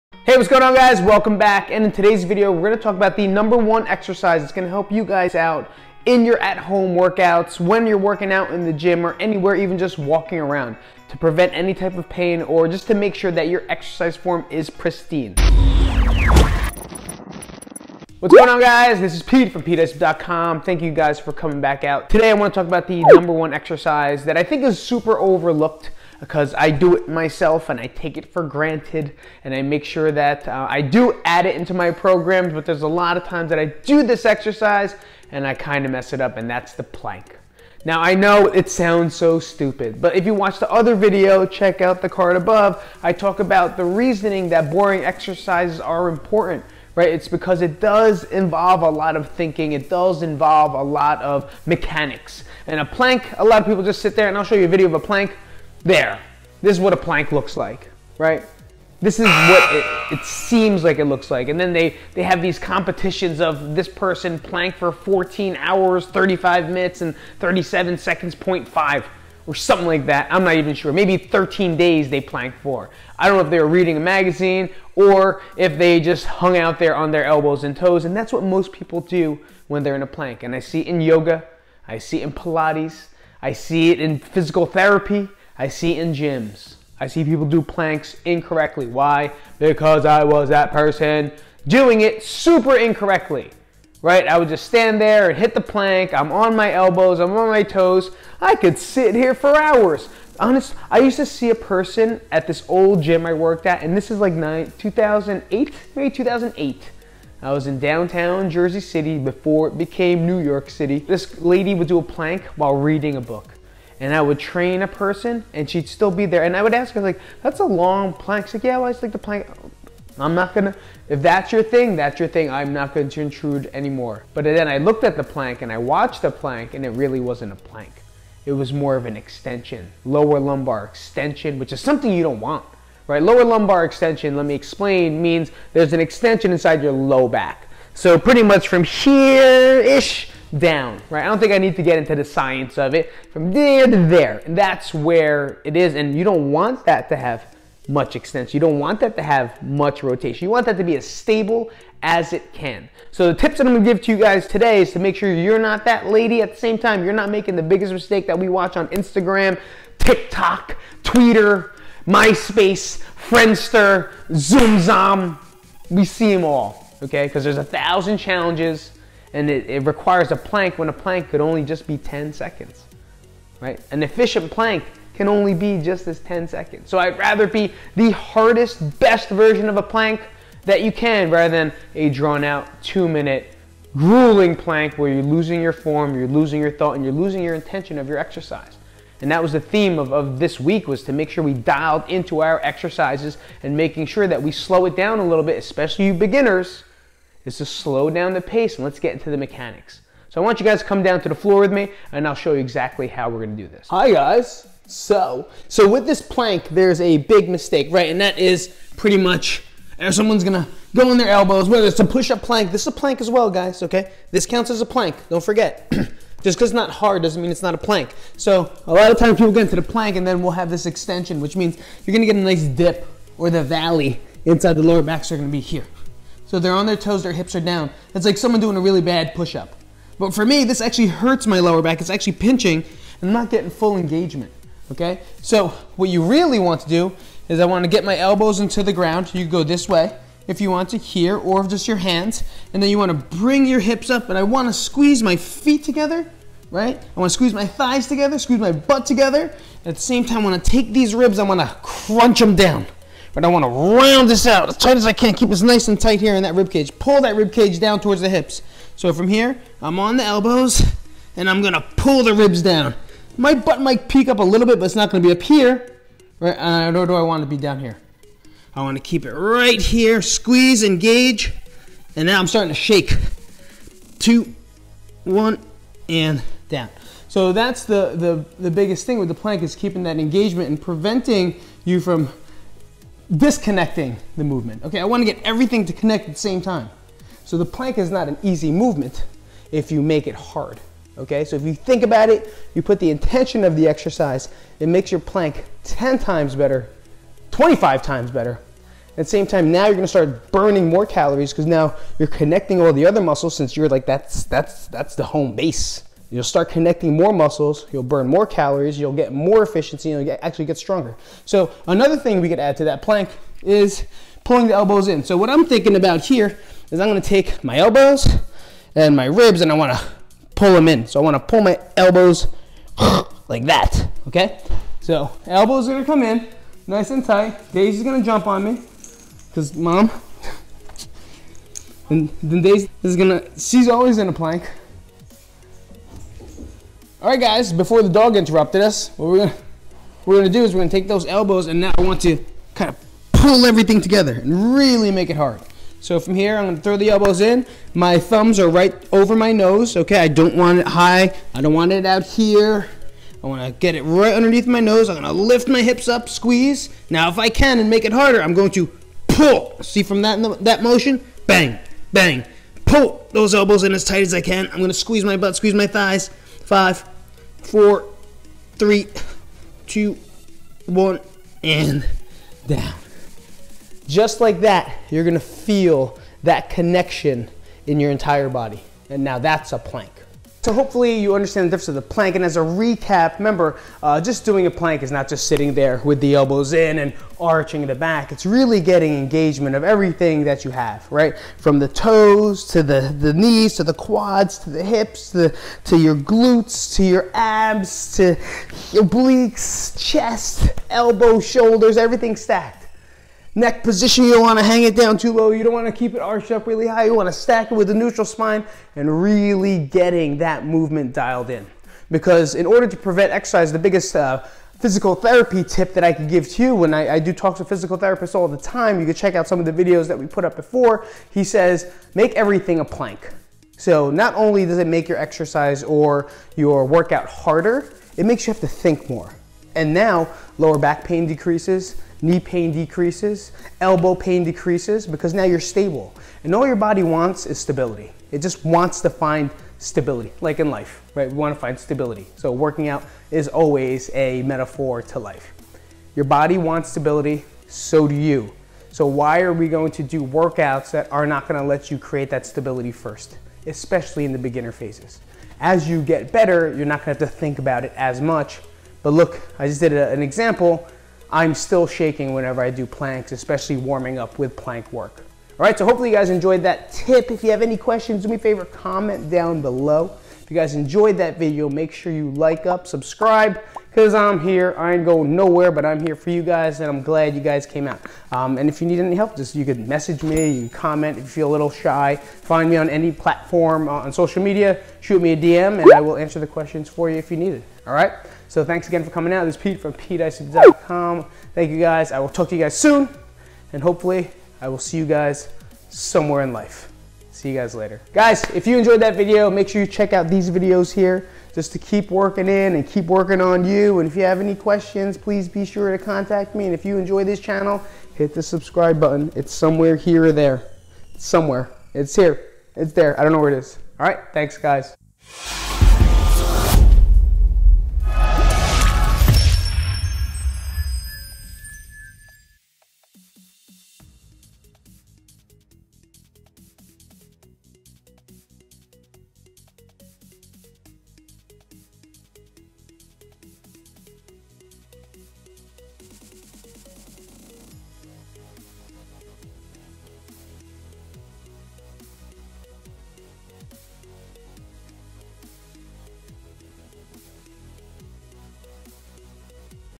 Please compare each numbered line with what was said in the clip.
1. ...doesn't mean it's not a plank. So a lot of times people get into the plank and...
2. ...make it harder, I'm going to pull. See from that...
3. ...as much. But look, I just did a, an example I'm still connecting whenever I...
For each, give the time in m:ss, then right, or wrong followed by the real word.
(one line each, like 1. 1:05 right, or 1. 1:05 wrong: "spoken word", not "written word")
1. 3:37 right
2. 5:57 right
3. 7:37 wrong: "shaking", not "connecting".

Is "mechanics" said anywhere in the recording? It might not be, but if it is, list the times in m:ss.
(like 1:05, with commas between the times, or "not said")
0:51, 3:19.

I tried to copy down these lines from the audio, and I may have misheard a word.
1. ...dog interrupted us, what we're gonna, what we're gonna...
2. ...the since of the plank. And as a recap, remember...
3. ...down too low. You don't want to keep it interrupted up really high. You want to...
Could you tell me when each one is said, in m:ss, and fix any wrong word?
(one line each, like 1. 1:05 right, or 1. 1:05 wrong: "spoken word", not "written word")
1. 5:38 right
2. 6:21 wrong: "difference", not "since"
3. 6:44 wrong: "arched", not "interrupted".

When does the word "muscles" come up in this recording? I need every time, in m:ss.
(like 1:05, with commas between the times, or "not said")
5:03, 5:07.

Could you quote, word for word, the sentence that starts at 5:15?
So what I'm thinking about here is I'm gonna take my elbows and my ribs and I wanna pull them in.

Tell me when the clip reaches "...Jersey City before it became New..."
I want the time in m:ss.
1:48.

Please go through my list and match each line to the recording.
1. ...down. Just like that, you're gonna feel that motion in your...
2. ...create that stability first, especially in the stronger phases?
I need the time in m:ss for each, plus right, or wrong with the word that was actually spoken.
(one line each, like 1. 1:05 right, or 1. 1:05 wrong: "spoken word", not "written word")
1. 6:12 wrong: "connection", not "motion"
2. 7:31 wrong: "beginner", not "stronger".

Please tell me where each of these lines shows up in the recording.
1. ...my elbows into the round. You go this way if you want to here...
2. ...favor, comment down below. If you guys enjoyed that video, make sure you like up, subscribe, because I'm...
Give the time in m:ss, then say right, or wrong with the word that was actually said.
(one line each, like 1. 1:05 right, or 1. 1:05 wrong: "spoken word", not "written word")
1. 3:58 wrong: "ground", not "round"
2. 7:48 right.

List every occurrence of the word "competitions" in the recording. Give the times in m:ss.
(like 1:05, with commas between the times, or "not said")
1:02.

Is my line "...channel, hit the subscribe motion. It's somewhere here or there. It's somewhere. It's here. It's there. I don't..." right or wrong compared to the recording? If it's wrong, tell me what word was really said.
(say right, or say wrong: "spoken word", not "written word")
wrong: "button", not "motion".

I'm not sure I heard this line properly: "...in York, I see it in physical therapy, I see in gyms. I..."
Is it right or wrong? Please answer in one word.
wrong.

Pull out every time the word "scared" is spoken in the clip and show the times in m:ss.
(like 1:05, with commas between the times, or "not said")
not said.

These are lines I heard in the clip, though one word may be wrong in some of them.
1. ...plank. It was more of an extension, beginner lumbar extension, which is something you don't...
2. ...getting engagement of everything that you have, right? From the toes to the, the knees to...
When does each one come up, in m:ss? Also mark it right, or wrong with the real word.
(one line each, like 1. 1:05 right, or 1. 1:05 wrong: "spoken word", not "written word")
1. 2:07 wrong: "lower", not "beginner"
2. 6:28 right.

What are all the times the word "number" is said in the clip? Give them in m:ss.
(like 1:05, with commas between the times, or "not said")
0:03, 0:23.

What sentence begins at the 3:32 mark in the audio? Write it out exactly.
This is a plank as well, guys, okay?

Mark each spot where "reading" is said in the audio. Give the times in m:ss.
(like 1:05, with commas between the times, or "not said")
1:13, 1:52.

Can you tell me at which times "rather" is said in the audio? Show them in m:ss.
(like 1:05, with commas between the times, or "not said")
2:57, 3:01.